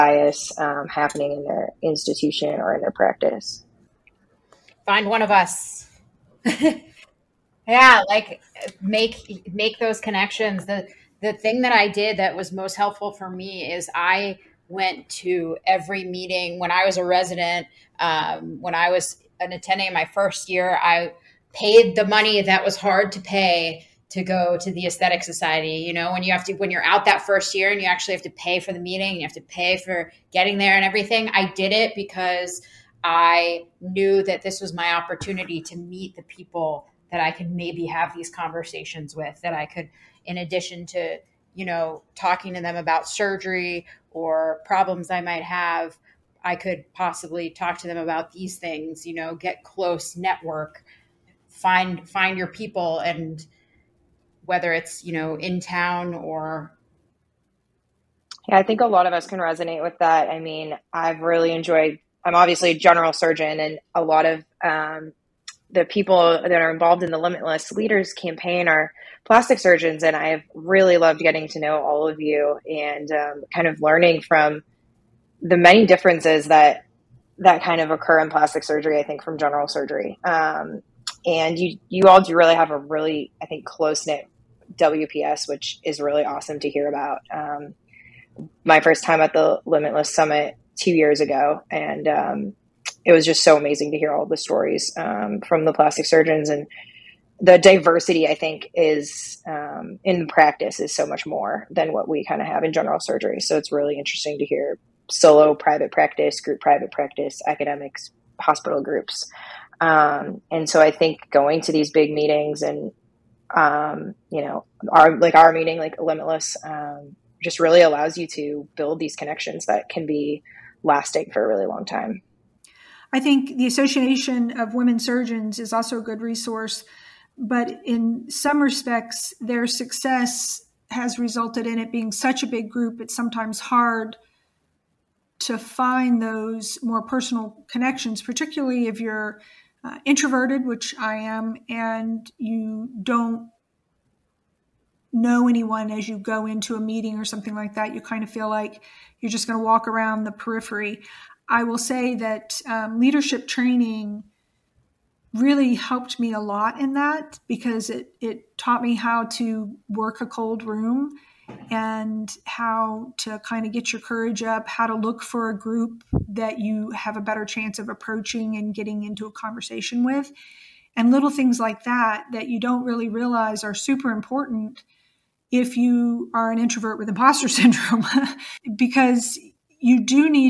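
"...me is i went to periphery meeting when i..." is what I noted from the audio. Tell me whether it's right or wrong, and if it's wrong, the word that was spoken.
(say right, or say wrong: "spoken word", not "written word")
wrong: "every", not "periphery".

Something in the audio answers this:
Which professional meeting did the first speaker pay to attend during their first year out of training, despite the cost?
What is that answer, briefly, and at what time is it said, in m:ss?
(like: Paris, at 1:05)
The Aesthetic Society, at 0:24.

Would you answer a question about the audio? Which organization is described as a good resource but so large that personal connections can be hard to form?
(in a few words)
Association of Women Surgeons.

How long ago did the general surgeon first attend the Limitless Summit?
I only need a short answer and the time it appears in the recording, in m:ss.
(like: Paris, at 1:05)
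2 years, at 1:30.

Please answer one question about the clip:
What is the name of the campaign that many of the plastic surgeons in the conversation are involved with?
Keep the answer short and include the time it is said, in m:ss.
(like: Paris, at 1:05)
Limitless Leaders, at 1:07.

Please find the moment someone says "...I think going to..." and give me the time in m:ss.
1:50.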